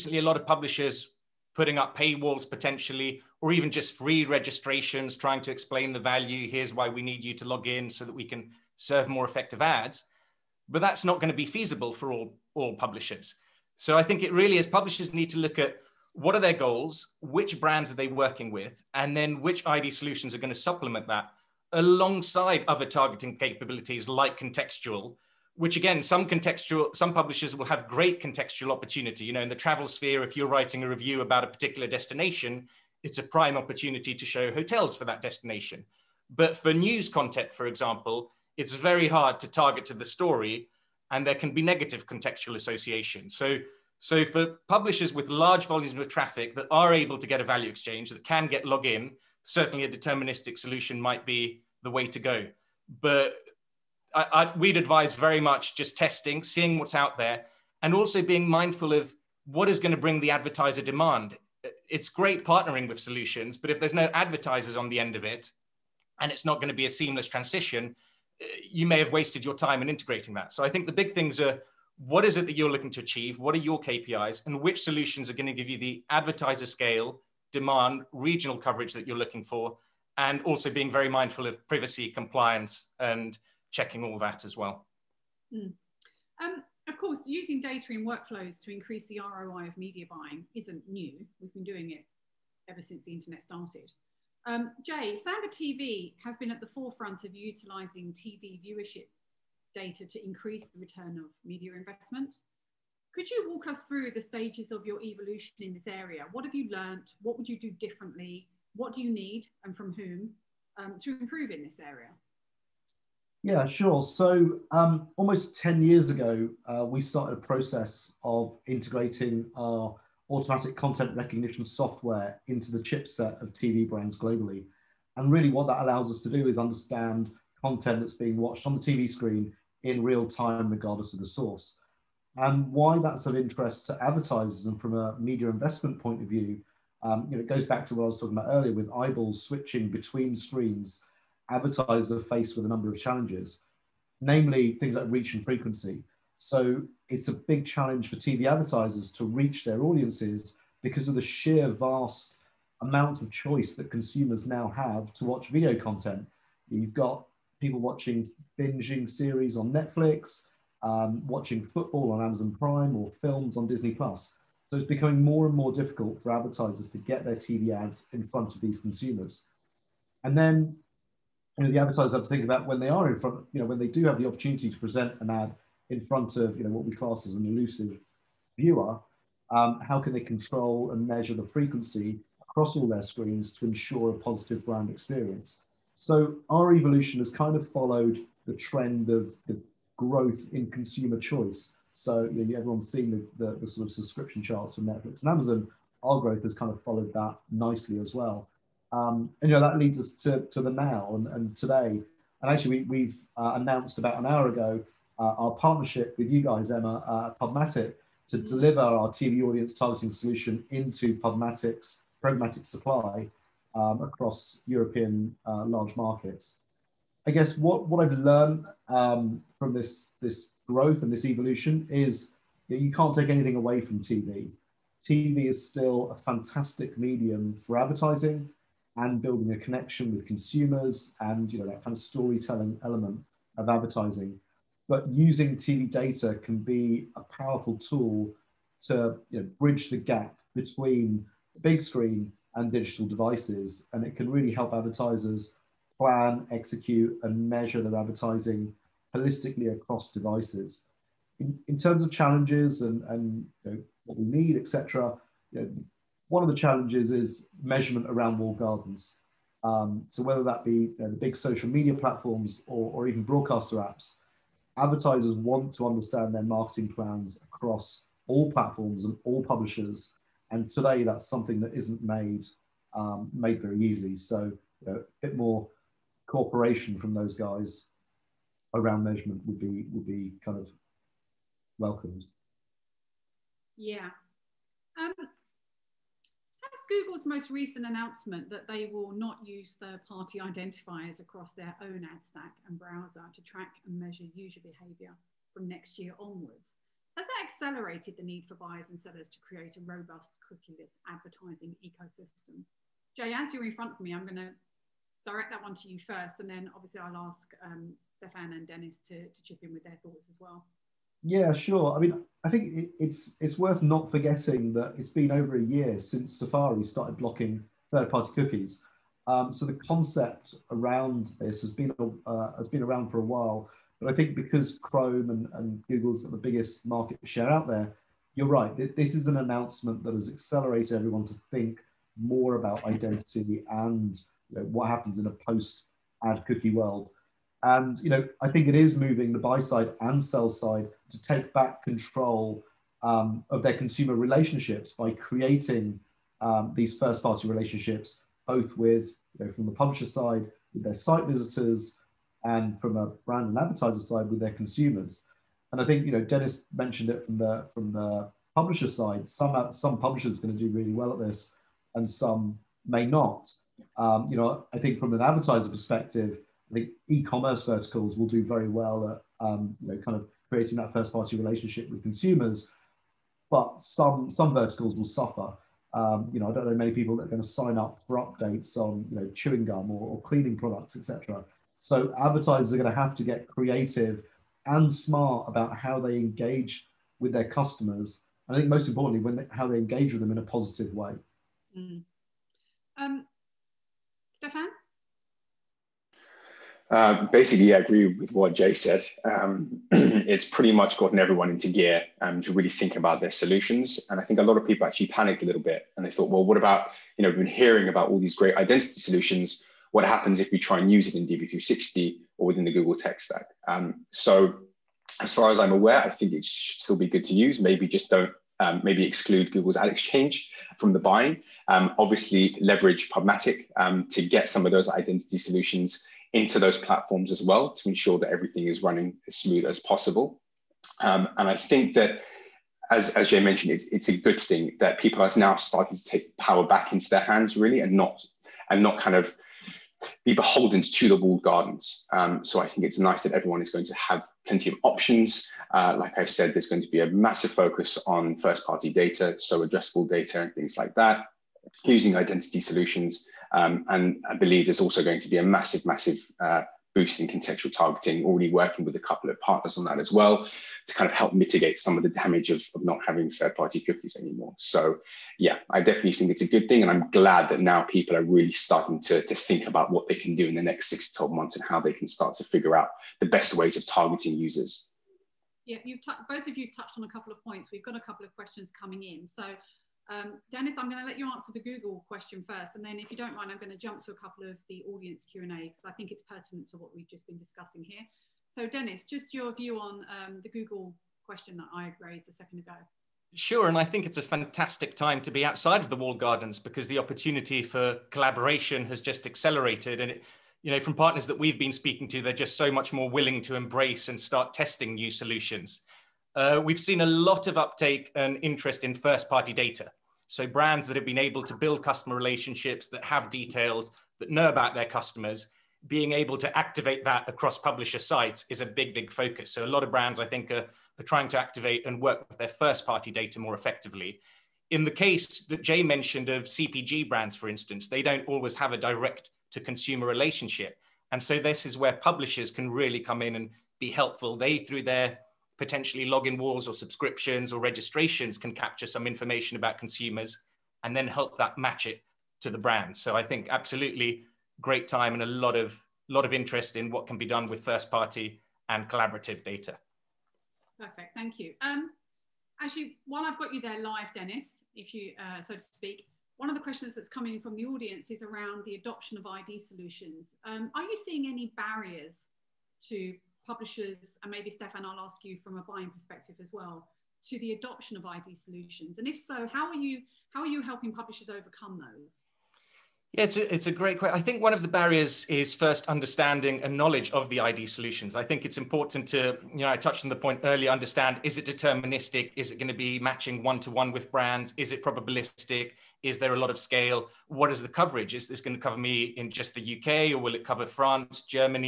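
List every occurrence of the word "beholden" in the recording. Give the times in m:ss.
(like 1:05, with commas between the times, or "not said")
7:20.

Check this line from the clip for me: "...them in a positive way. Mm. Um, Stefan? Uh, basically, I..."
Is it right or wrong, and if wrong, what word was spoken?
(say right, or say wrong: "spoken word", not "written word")
right.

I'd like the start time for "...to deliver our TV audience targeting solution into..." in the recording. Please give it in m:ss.
3:28.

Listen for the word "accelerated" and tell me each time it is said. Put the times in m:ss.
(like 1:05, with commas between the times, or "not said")
4:57, 5:30, 8:19.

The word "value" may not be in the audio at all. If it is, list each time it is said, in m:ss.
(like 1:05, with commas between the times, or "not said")
0:05, 0:47.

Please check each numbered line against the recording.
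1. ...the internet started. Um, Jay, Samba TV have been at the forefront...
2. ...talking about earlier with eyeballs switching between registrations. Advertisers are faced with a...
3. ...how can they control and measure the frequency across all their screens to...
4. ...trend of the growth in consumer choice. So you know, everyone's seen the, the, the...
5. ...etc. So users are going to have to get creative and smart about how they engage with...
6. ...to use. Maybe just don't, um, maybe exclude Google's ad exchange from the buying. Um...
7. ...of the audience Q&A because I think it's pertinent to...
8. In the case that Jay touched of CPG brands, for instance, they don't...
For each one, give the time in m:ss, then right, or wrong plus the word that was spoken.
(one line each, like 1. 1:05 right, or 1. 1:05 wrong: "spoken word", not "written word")
1. 1:33 right
2. 2:18 wrong: "screens", not "registrations"
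3. 2:59 right
4. 3:08 right
5. 6:20 wrong: "advertisers", not "users"
6. 6:57 right
7. 8:04 right
8. 8:44 wrong: "mentioned", not "touched".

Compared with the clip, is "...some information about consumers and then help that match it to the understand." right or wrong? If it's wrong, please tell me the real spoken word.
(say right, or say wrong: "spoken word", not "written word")
wrong: "brand", not "understand".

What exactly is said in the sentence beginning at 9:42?
Is it going to be matching one to one with brands?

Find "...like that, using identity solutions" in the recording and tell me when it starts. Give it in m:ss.
7:30.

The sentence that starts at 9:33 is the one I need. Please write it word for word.
Yeah, it's a, it's a great question.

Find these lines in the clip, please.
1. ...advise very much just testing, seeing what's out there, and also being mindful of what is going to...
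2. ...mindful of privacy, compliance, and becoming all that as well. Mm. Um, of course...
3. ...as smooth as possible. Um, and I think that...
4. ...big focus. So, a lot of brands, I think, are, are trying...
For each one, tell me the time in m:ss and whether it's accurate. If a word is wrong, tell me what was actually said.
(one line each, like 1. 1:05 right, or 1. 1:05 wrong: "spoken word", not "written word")
1. 0:54 right
2. 1:21 wrong: "checking", not "becoming"
3. 7:09 right
4. 8:38 right.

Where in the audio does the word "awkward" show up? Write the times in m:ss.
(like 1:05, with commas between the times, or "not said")
not said.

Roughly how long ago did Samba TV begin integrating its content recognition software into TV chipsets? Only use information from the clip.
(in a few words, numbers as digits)
Almost 10 years.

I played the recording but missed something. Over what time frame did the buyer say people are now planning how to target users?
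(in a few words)
6 to 12 months.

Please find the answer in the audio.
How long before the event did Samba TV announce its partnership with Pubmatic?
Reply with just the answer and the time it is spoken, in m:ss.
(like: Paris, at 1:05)
About an hour, at 3:23.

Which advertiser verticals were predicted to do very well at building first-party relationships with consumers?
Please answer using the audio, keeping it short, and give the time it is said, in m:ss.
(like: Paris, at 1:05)
E-commerce, at 6:07.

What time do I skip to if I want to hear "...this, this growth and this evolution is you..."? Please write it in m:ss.
3:39.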